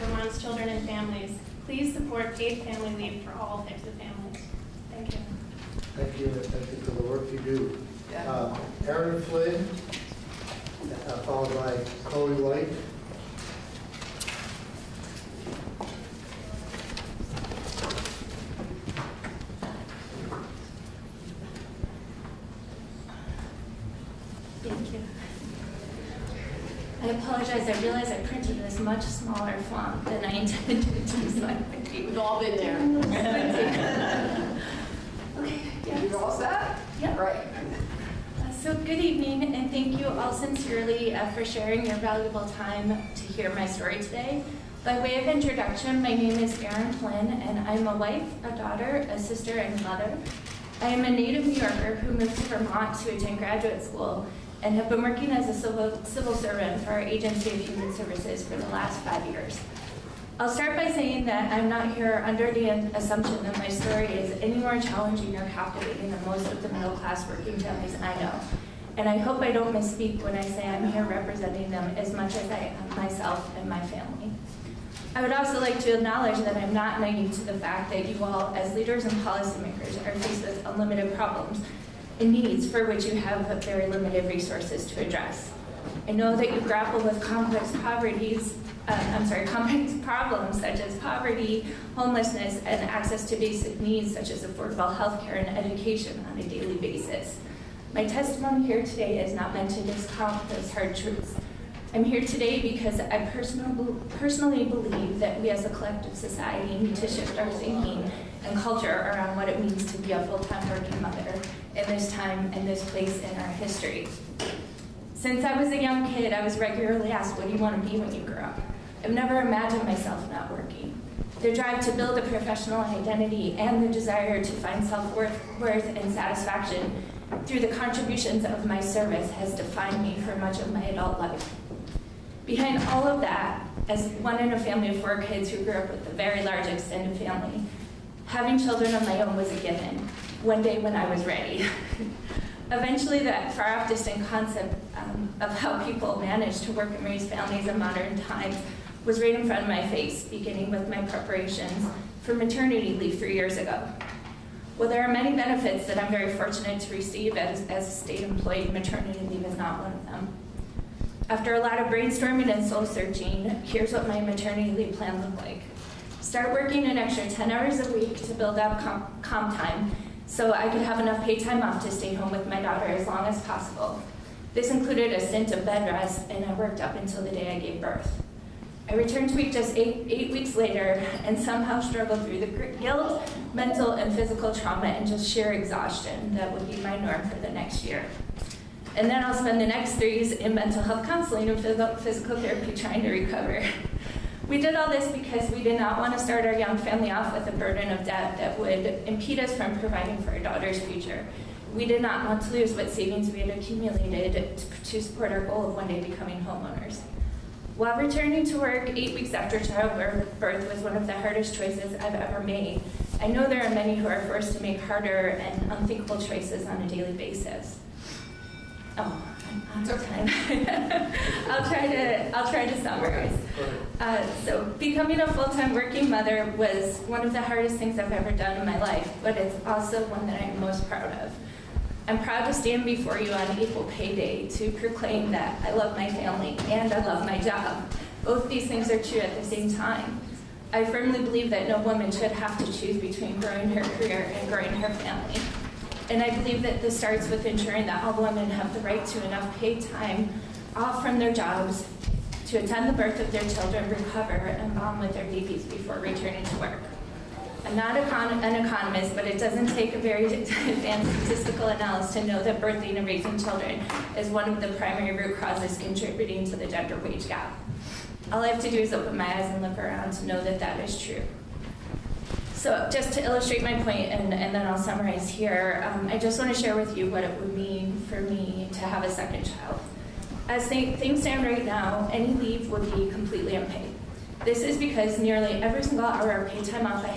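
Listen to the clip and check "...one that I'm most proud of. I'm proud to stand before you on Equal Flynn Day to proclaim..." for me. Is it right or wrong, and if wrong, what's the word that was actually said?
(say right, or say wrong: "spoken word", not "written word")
wrong: "Pay", not "Flynn".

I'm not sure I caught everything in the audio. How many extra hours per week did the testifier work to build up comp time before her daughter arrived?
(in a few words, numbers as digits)
10.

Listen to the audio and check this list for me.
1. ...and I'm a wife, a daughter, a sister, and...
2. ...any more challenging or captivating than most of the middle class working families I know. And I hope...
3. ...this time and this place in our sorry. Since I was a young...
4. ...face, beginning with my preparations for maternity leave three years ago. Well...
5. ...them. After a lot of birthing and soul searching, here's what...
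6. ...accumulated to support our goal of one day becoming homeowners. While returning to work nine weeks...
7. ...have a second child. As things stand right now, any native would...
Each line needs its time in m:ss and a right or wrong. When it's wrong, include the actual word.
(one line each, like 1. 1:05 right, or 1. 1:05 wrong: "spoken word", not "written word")
1. 0:47 right
2. 1:04 right
3. 1:51 wrong: "history", not "sorry"
4. 2:29 right
5. 2:40 wrong: "brainstorming", not "birthing"
6. 3:23 wrong: "eight", not "nine"
7. 4:38 wrong: "leave", not "native".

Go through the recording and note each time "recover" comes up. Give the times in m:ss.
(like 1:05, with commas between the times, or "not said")
3:13, 4:13.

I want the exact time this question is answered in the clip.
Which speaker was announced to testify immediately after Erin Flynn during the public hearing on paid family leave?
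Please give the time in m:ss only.
0:12.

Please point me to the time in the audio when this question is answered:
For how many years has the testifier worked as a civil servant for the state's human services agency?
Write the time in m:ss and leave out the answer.
0:59.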